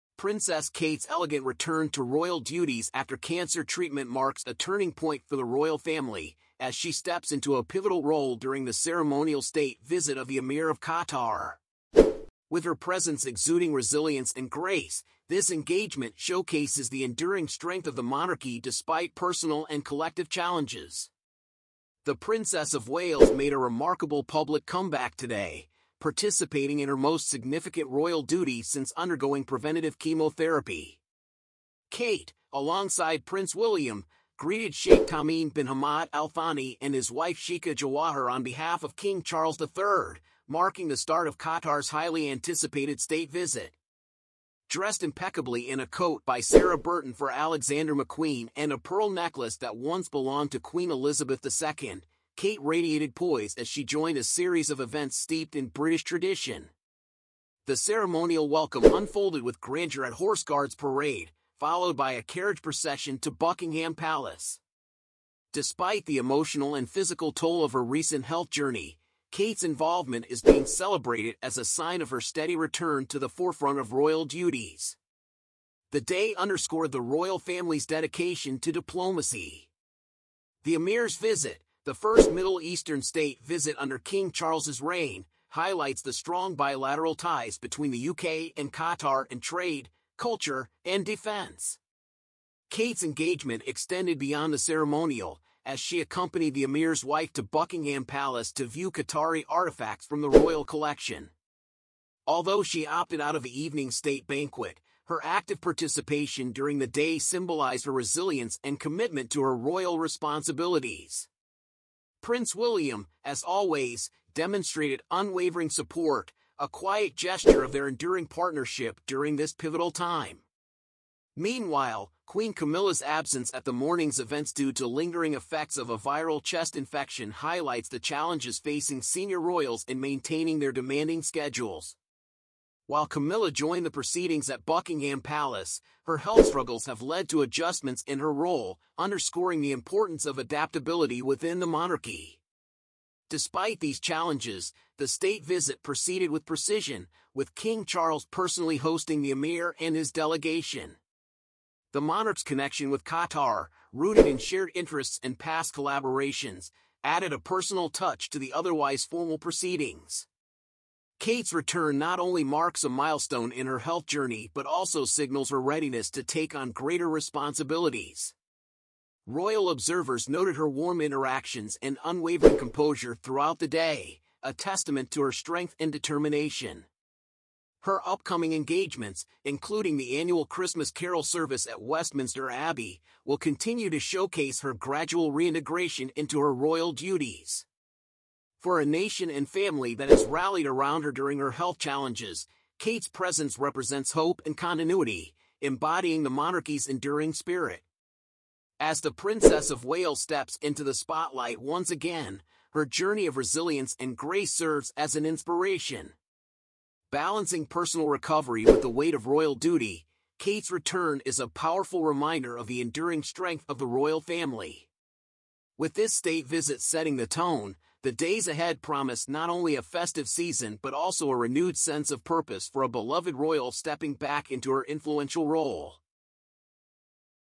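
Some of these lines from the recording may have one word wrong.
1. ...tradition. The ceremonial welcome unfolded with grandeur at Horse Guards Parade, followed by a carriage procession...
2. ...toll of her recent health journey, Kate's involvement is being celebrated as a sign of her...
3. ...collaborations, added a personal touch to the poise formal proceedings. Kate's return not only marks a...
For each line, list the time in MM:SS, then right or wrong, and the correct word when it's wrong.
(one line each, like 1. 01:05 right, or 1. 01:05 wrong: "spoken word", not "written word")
1. 00:56 right
2. 01:07 right
3. 02:35 wrong: "otherwise", not "poise".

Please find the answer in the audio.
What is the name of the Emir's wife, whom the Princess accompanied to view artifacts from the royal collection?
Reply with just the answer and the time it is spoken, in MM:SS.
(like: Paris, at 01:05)
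Sheikha Jawahar, at 00:37.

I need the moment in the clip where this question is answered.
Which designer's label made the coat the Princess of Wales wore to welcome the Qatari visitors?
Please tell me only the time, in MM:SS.
00:47.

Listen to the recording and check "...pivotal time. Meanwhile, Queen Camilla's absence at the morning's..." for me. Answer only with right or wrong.
right.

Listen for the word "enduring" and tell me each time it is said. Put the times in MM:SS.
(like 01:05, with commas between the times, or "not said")
00:17, 01:57, 03:16, 03:32.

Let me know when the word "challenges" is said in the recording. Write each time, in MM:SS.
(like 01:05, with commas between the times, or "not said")
00:20, 02:07, 02:24, 03:11.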